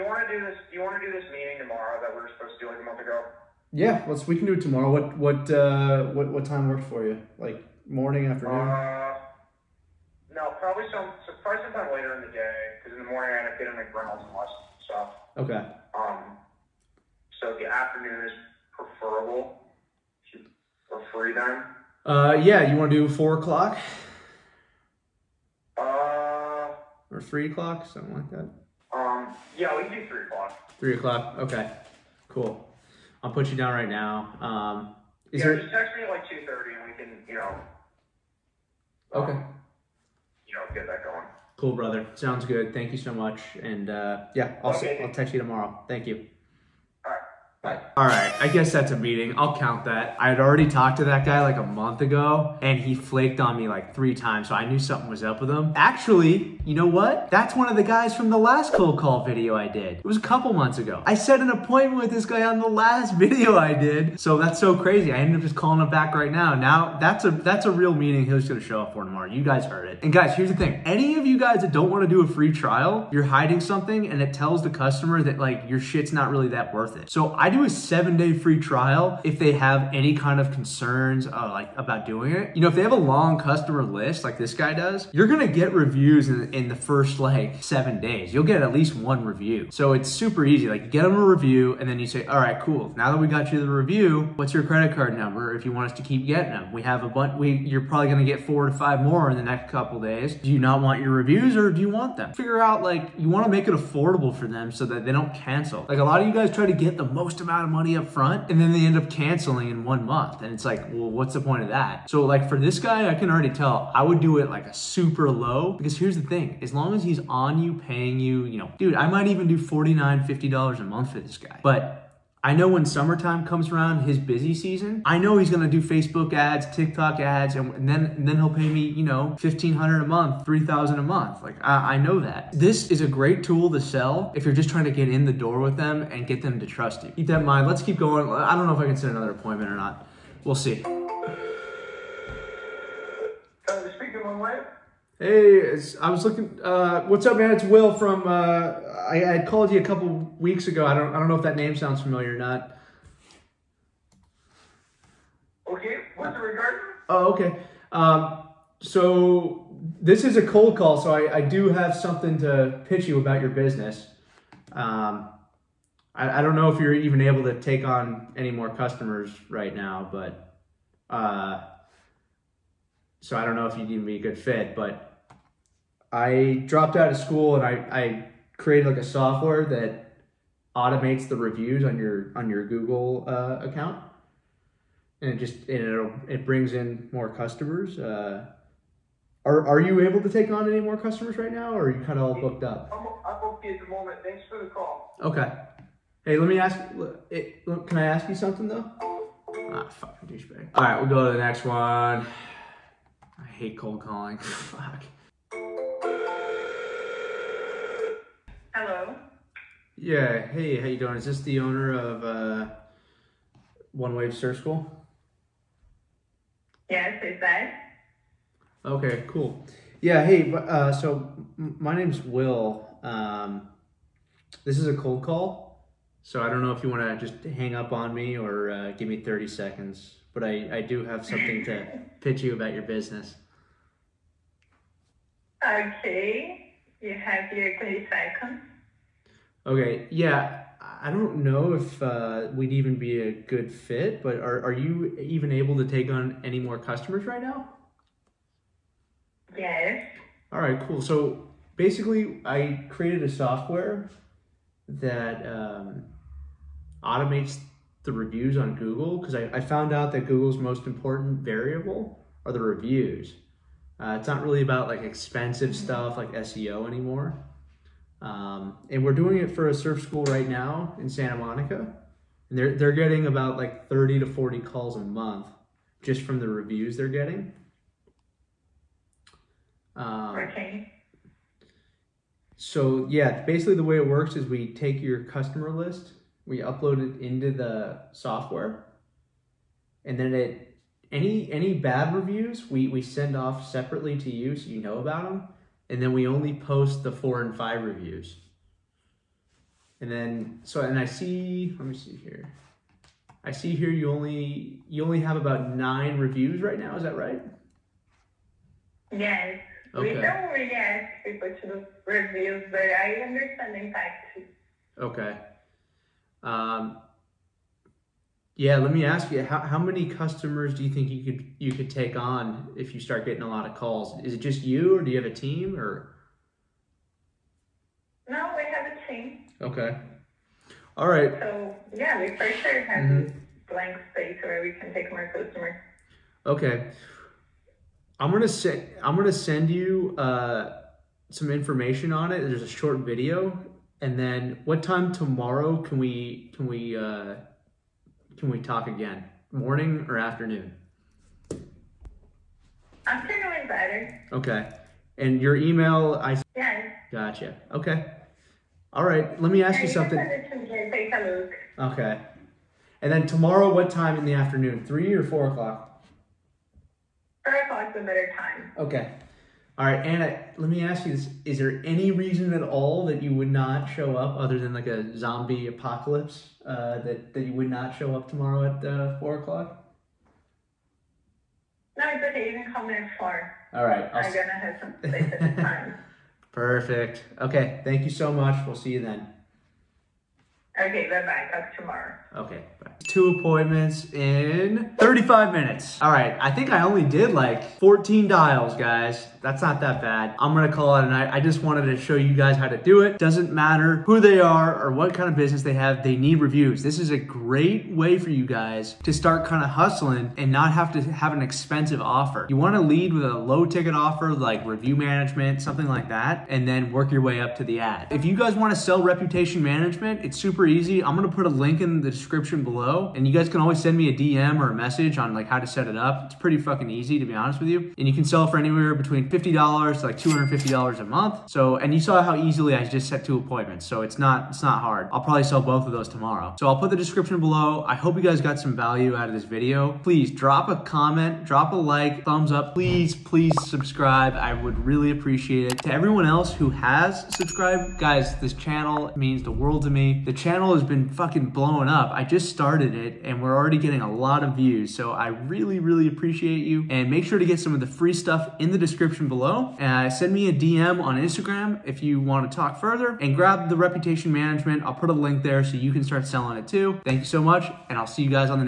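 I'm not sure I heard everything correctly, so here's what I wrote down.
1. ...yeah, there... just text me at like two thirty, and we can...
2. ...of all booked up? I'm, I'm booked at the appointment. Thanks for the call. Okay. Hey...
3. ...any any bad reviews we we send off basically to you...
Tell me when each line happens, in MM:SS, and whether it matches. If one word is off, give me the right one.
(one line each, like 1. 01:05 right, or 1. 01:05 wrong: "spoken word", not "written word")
1. 00:35 right
2. 03:12 wrong: "moment", not "appointment"
3. 04:51 wrong: "separately", not "basically".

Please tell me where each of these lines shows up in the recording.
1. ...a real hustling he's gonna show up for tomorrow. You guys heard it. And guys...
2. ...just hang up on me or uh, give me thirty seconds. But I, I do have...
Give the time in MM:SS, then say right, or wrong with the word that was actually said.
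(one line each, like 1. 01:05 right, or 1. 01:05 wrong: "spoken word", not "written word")
1. 01:07 wrong: "meeting", not "hustling"
2. 03:47 right.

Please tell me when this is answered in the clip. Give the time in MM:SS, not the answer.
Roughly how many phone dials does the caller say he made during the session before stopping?
06:37.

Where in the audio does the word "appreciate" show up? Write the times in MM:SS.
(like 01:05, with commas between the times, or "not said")
07:25, 07:36.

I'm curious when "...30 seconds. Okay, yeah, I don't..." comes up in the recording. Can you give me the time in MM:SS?
03:57.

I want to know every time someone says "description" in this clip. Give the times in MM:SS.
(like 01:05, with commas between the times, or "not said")
07:02, 07:16, 07:38.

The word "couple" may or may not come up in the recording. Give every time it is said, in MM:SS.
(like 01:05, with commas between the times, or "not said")
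01:00, 01:39, 02:29.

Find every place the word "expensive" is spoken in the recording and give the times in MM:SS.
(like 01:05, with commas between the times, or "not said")
04:25, 06:51.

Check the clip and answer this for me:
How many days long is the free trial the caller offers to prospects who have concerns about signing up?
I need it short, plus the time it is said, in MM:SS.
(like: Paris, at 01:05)
7, at 01:17.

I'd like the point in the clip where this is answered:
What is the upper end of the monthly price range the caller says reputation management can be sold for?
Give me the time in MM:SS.
07:10.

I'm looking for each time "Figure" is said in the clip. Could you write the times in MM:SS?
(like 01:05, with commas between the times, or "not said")
01:42.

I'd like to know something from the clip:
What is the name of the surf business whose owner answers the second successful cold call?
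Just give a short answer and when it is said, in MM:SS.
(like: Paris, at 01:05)
One Wave Surf School, at 03:33.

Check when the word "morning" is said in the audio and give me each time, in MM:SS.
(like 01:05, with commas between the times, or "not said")
00:07, 00:13, 05:49.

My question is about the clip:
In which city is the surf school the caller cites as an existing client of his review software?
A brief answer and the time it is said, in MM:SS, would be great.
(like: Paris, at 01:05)
Santa Monica, at 04:31.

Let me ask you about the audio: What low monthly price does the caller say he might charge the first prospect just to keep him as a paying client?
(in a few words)
$49.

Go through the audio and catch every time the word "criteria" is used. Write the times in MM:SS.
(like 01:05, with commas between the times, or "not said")
not said.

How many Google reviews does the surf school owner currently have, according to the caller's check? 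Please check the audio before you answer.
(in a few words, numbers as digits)
9.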